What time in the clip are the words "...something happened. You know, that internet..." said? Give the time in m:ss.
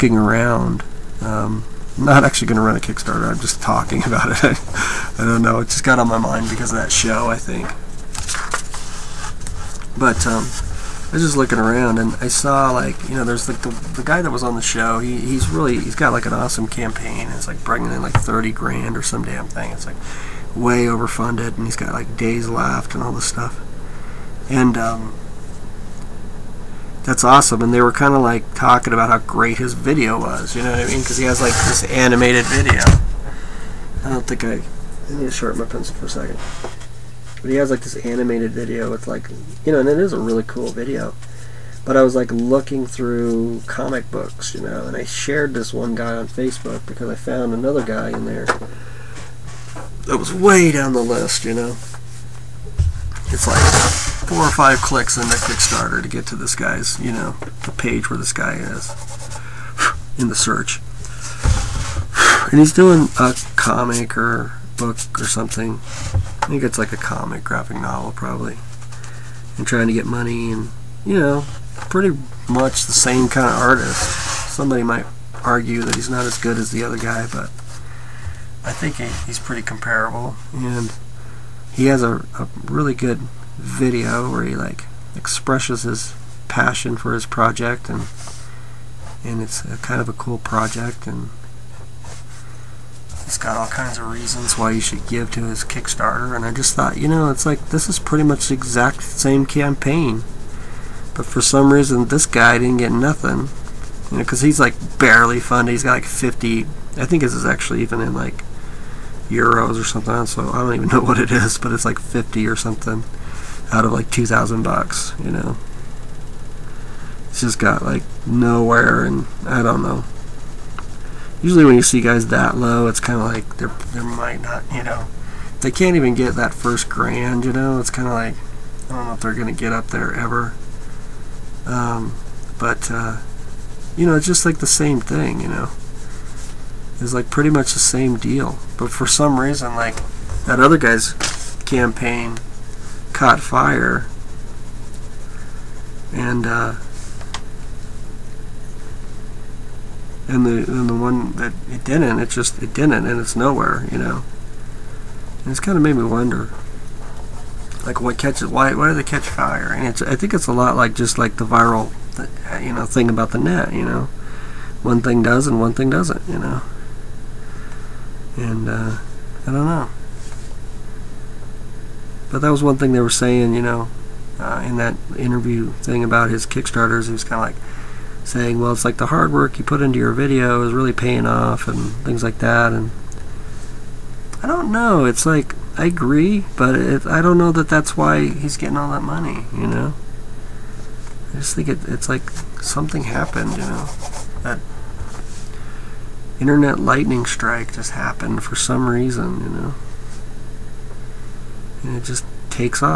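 3:12.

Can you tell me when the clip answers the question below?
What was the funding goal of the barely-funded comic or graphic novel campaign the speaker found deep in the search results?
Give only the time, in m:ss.
1:54.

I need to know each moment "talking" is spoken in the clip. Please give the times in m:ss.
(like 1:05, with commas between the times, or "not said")
0:03, 0:28.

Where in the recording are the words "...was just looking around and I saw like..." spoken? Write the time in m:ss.
0:11.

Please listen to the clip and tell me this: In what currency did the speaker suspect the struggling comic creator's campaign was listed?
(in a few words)
euros.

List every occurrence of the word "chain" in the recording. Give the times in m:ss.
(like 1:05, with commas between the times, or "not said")
not said.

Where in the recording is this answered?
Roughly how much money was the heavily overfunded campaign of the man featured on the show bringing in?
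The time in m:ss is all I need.
0:18.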